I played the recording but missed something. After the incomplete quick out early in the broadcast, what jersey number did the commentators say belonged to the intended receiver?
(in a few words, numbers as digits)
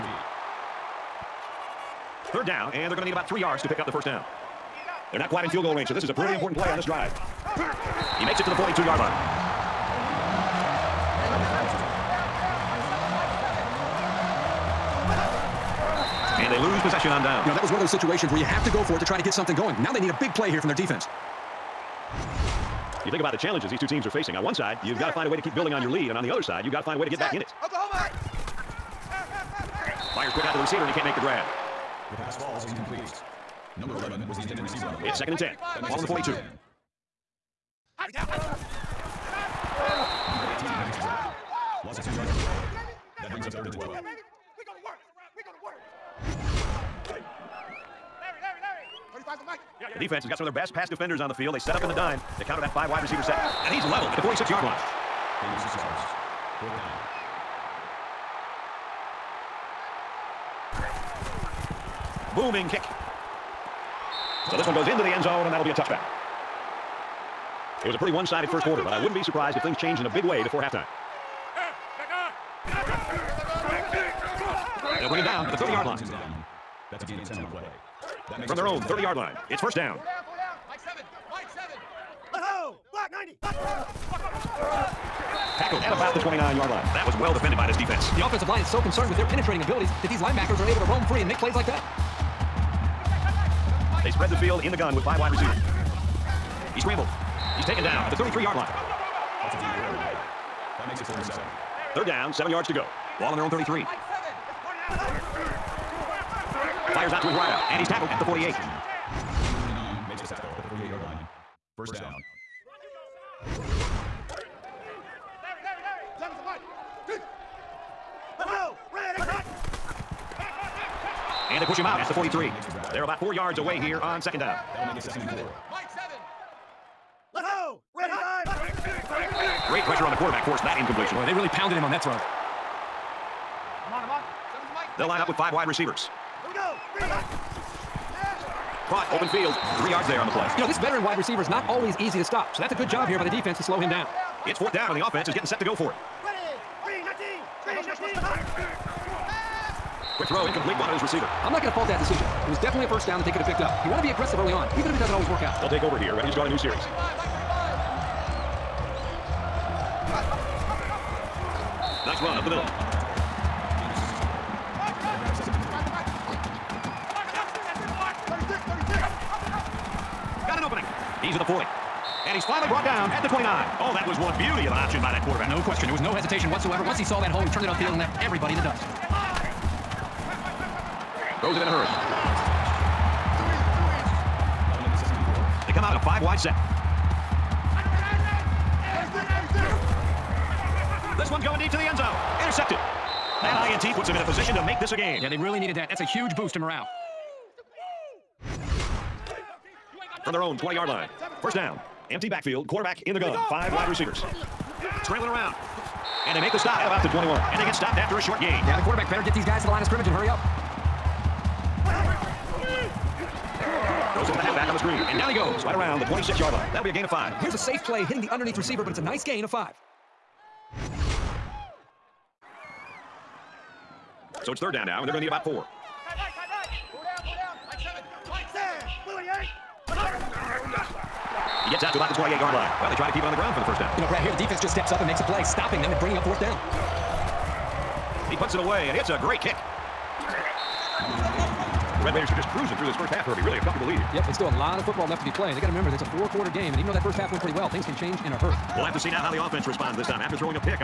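11.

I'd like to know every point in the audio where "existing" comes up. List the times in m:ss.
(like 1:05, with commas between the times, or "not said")
not said.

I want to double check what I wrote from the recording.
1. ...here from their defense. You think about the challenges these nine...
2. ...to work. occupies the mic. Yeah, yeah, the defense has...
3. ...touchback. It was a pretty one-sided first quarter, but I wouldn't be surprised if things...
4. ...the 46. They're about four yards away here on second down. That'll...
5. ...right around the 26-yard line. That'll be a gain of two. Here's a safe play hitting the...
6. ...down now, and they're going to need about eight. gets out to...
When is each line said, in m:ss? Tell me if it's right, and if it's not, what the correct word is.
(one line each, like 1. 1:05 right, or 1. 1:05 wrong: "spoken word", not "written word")
1. 0:20 wrong: "two", not "nine"
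2. 0:45 right
3. 1:05 right
4. 2:02 wrong: "43", not "46"
5. 3:35 wrong: "five", not "two"
6. 3:44 wrong: "four", not "eight".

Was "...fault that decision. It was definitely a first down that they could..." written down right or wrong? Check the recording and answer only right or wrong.
right.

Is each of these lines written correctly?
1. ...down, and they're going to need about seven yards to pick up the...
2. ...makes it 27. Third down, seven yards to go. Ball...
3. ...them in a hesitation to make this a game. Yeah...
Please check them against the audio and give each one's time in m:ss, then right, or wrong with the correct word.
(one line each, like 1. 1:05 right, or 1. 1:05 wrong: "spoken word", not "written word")
1. 0:02 wrong: "three", not "seven"
2. 1:40 wrong: "47", not "27"
3. 3:14 wrong: "position", not "hesitation".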